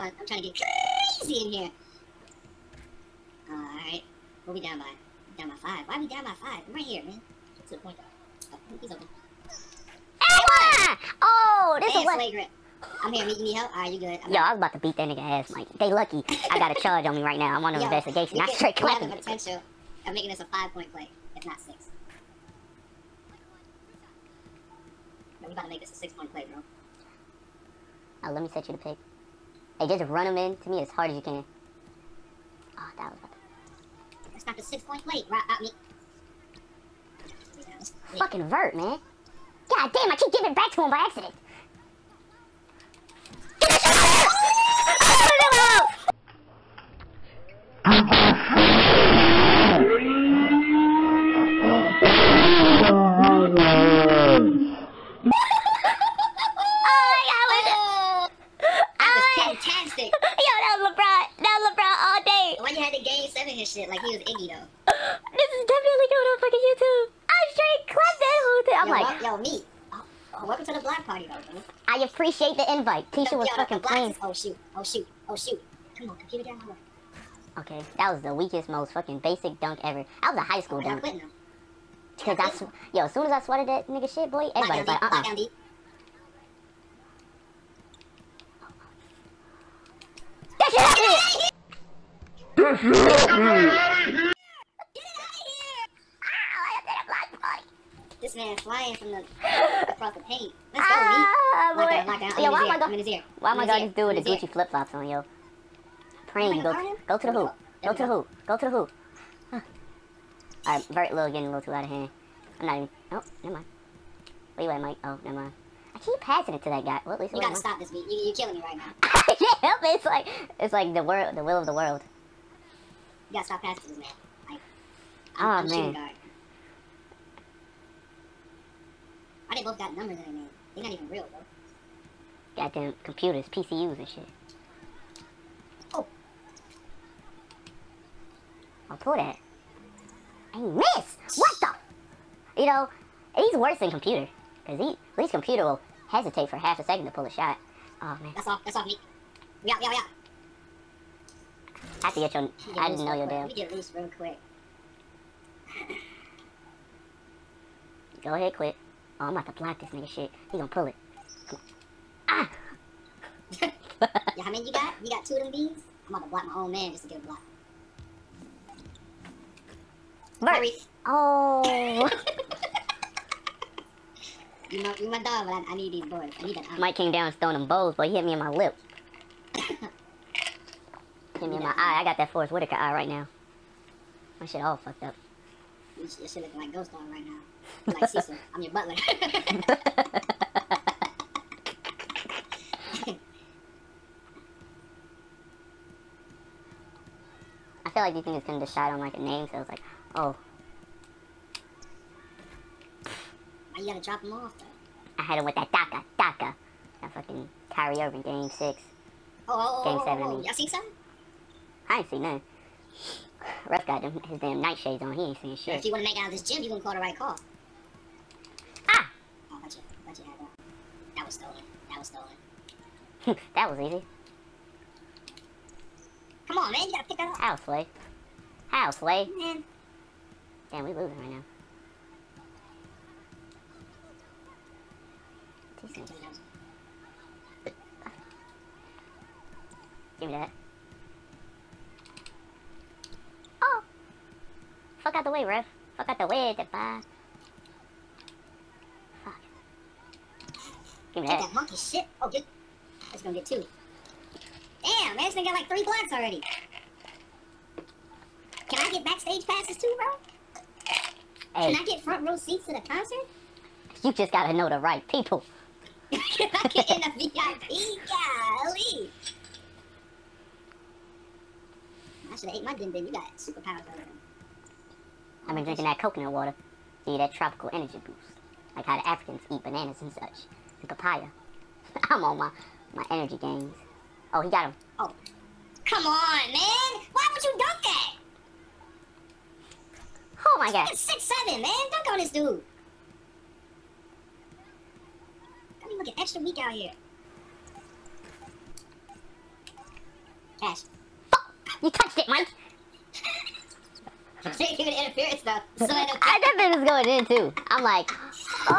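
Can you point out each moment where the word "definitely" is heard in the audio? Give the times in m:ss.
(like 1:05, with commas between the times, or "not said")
1:05, 5:06.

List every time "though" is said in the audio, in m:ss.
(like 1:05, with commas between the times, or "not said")
1:04, 1:11, 3:24, 5:05.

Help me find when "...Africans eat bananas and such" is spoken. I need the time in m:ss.
4:39.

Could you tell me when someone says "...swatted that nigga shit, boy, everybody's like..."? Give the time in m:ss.
1:23.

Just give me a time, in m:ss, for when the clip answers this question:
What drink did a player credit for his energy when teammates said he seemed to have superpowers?
4:35.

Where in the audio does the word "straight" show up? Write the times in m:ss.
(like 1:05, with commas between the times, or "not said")
0:18, 1:07.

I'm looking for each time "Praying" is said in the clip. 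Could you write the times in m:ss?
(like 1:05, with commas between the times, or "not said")
1:46.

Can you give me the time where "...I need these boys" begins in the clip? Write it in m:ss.
2:55.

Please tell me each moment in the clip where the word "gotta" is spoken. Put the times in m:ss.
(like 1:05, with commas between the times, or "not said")
1:57, 2:03, 3:23, 3:46, 4:24.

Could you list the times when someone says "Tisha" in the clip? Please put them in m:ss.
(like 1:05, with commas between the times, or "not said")
1:13.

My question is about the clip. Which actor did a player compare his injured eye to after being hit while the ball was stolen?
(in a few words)
Forest Whitaker.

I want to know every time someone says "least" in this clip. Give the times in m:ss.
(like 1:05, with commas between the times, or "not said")
1:57, 2:25.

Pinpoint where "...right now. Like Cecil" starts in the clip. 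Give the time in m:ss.
3:07.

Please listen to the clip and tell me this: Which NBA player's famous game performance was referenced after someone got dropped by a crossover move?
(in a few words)
Kyrie Irving.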